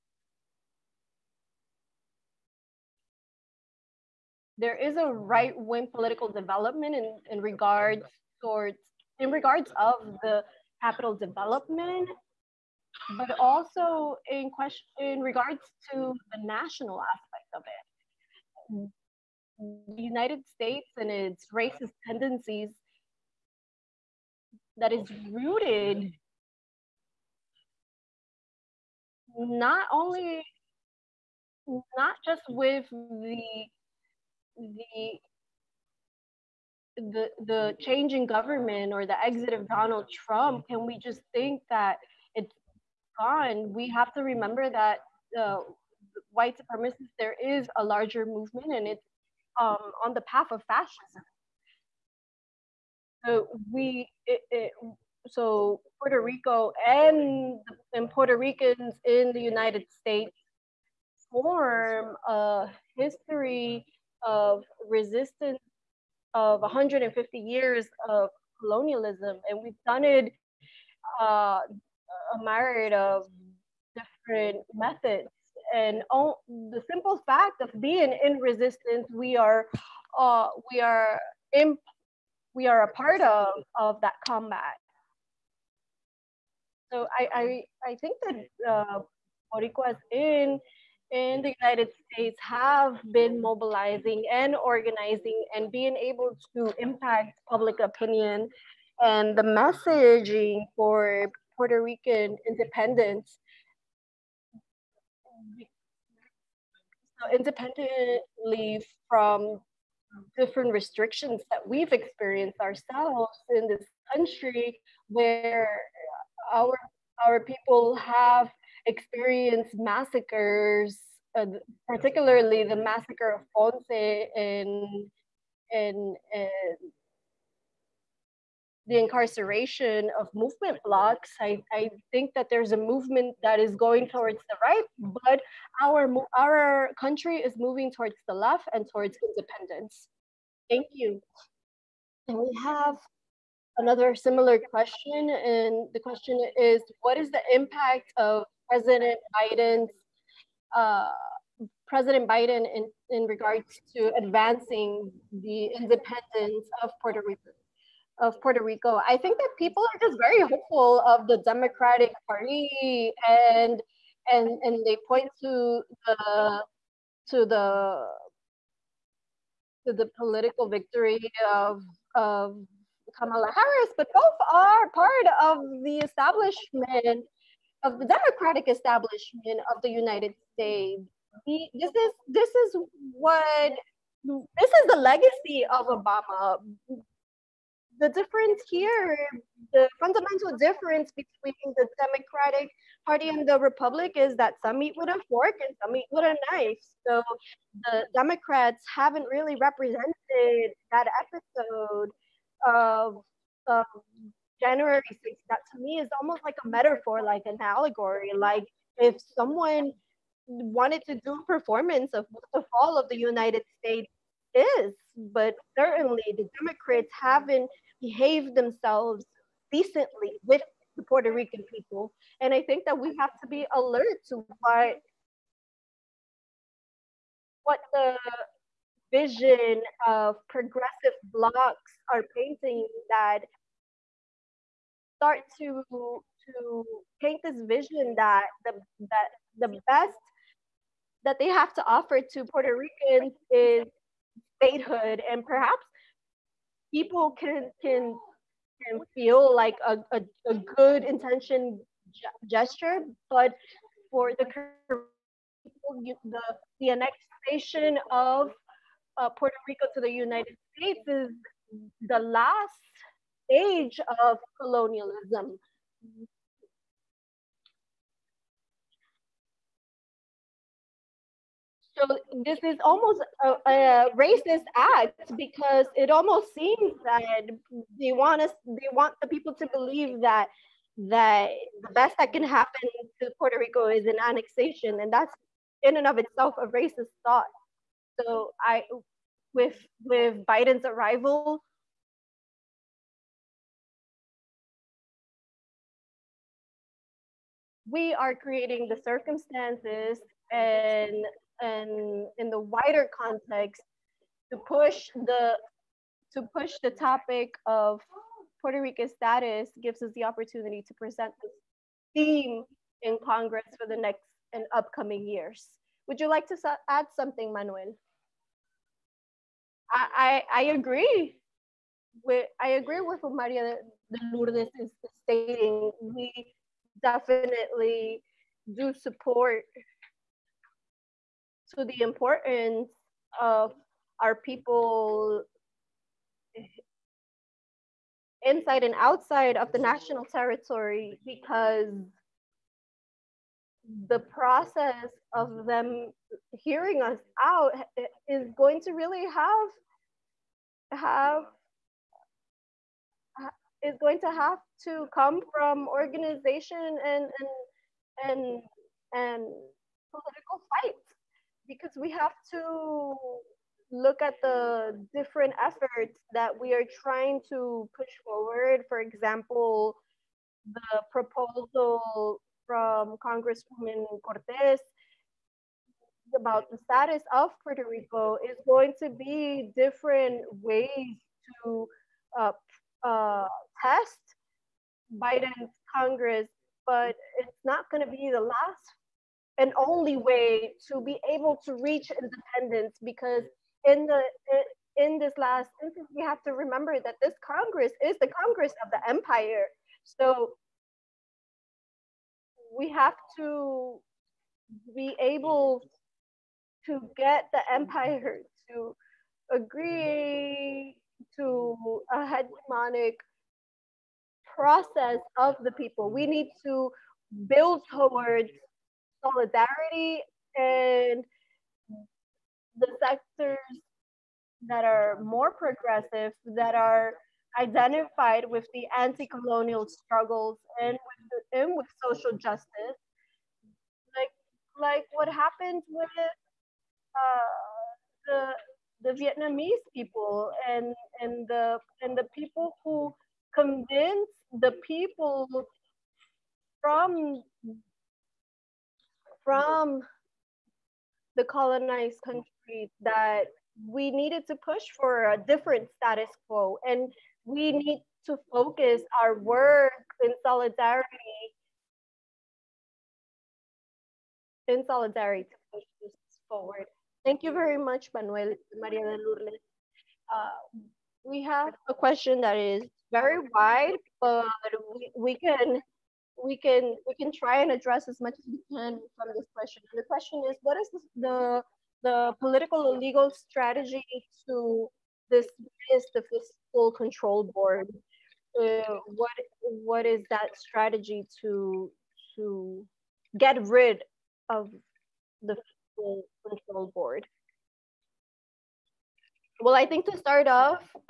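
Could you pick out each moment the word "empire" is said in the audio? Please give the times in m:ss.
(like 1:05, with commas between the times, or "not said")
6:39, 6:47.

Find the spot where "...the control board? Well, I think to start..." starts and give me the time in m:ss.
8:15.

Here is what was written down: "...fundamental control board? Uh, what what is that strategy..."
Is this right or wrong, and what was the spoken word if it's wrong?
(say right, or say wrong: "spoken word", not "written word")
wrong: "fiscal", not "fundamental".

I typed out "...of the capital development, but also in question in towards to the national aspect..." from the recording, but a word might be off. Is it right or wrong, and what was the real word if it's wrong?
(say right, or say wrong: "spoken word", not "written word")
wrong: "regards", not "towards".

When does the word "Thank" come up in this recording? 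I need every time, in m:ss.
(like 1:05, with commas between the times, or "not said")
2:20, 7:47.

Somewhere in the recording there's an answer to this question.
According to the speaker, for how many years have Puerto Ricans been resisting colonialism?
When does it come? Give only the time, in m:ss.
1:06.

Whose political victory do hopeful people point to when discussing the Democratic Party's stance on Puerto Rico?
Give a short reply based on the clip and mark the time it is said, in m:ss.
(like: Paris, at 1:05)
Kamala Harris, at 2:53.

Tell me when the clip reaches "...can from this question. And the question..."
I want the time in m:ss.
7:58.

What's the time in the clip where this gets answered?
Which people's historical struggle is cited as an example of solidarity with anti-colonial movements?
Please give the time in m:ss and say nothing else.
7:19.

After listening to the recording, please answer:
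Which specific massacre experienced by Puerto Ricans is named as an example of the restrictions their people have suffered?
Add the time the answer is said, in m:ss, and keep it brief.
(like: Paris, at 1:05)
Massacre of Ponce, at 2:02.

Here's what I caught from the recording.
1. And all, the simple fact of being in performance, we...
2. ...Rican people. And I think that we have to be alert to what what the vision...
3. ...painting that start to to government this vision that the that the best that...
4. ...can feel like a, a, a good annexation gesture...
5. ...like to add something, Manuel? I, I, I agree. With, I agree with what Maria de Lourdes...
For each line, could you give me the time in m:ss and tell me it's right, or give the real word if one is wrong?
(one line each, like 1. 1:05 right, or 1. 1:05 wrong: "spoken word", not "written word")
1. 1:15 wrong: "resistance", not "performance"
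2. 3:41 right
3. 3:52 wrong: "paint", not "government"
4. 4:08 wrong: "intention", not "annexation"
5. 5:16 right.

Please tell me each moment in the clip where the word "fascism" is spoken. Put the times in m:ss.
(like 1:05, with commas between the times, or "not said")
0:50.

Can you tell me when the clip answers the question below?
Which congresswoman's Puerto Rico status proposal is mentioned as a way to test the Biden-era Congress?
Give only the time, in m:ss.
6:14.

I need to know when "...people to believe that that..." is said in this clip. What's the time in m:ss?
4:39.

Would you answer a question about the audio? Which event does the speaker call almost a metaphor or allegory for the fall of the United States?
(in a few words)
January 6th.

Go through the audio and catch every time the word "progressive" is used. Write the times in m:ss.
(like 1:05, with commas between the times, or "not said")
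3:50, 7:05.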